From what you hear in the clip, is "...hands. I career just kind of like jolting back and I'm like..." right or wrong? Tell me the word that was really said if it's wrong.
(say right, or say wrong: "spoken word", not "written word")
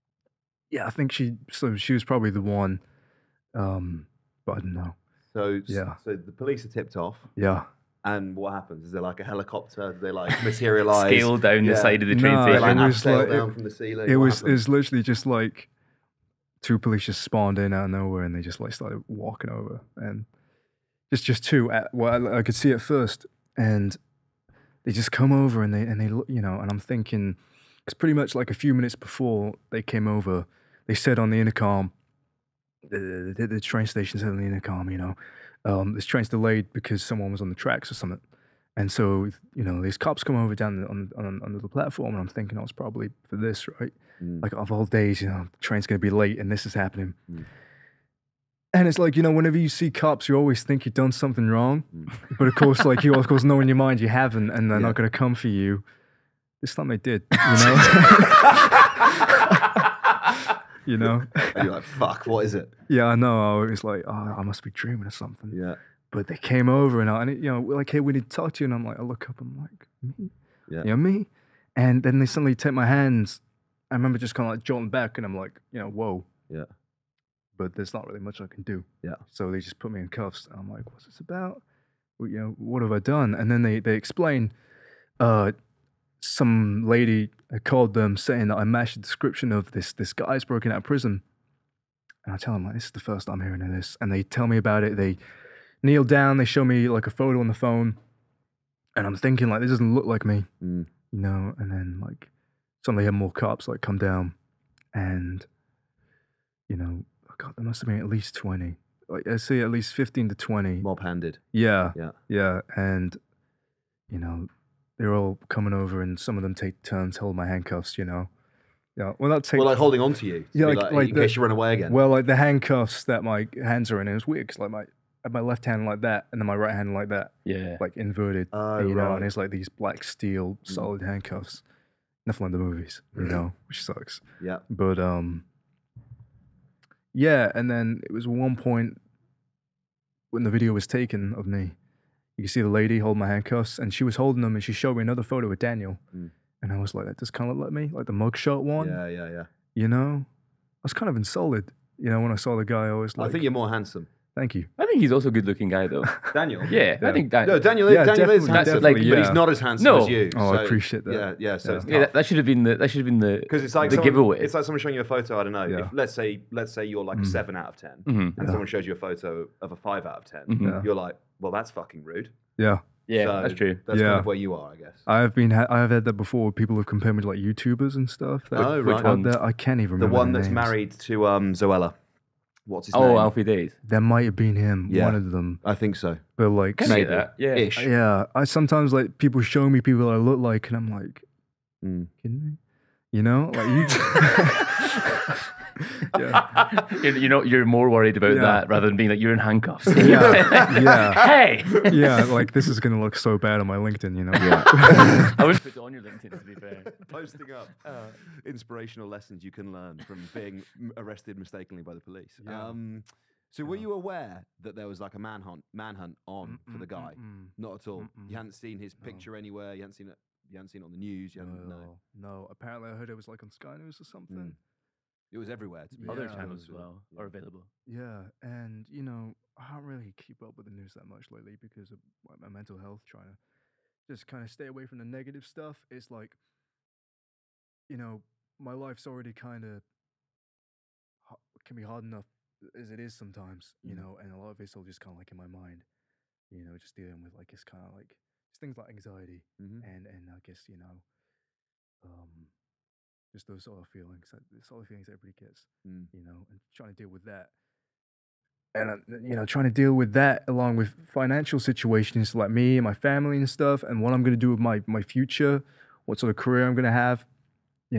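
wrong: "remember", not "career".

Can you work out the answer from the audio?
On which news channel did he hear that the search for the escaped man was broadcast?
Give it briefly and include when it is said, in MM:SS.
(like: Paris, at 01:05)
Sky News, at 03:43.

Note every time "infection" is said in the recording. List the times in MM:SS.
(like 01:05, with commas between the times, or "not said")
not said.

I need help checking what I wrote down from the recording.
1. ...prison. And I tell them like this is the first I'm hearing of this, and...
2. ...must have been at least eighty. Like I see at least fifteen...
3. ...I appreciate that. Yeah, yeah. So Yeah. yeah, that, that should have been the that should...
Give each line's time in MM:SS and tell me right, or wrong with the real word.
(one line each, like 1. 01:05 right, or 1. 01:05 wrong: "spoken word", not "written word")
1. 01:30 right
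2. 01:47 wrong: "twenty", not "eighty"
3. 02:40 right.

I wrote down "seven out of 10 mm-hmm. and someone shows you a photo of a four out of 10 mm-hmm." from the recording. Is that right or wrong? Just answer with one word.
wrong.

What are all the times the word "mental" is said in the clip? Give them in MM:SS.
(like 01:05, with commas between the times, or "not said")
03:52.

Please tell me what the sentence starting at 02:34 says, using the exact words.
I think he's also a good looking guy, though.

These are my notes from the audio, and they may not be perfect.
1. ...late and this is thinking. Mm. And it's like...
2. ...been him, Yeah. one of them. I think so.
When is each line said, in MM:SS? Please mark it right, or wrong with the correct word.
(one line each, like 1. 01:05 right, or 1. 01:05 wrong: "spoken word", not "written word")
1. 00:46 wrong: "happening", not "thinking"
2. 03:04 right.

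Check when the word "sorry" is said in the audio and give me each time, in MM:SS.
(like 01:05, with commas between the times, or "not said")
not said.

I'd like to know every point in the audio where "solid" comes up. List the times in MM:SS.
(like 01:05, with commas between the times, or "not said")
02:10.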